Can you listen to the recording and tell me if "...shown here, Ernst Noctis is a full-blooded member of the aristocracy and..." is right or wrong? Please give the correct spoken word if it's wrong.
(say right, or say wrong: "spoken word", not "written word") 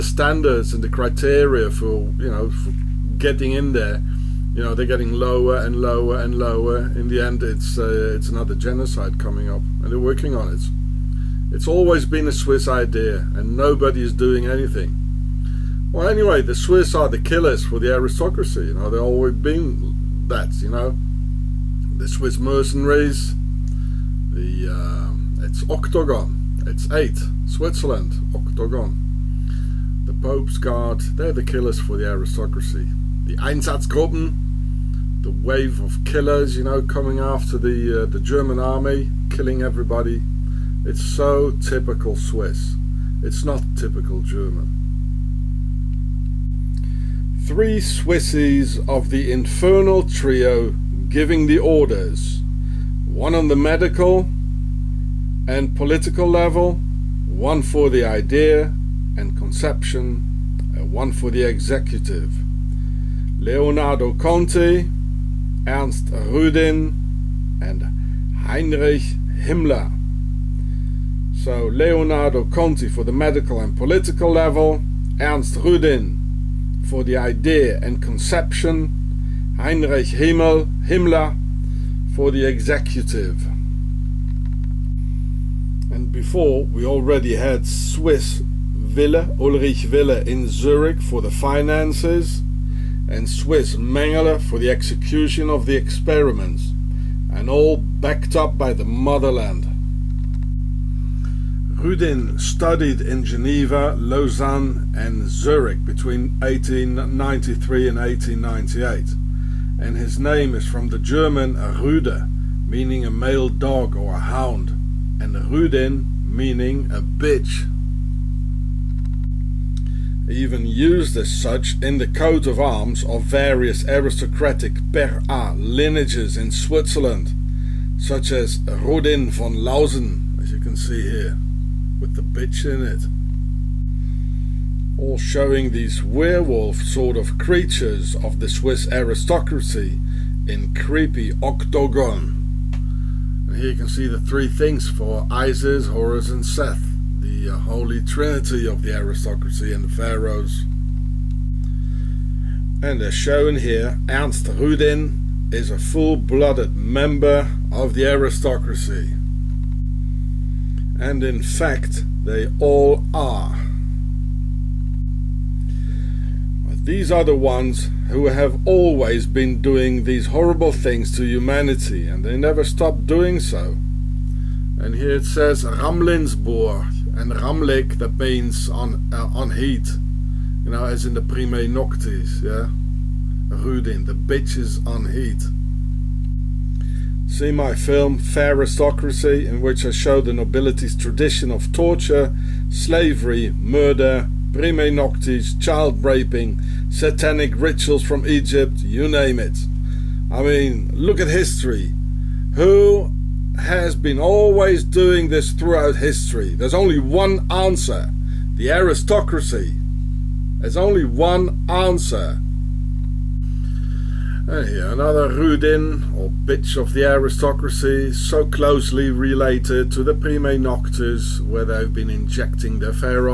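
wrong: "Rudin", not "Noctis".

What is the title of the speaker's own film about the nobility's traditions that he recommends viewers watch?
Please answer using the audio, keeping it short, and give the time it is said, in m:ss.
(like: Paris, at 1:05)
Fair Aristocracy, at 3:08.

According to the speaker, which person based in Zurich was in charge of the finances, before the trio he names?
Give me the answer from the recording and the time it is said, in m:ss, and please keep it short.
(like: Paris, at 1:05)
Ulrich Wille, at 1:29.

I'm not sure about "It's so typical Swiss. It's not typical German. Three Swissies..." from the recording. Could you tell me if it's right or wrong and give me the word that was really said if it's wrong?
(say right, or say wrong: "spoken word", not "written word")
right.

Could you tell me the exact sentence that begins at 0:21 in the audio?
The Swiss mercenaries, the uh, it's Octagon, it's 8, Switzerland, Octagon.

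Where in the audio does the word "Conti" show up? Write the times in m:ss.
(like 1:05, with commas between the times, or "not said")
1:04, 1:12.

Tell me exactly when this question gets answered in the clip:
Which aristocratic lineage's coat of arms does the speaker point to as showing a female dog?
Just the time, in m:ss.
2:08.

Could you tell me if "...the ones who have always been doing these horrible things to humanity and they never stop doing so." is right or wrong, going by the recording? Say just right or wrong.
right.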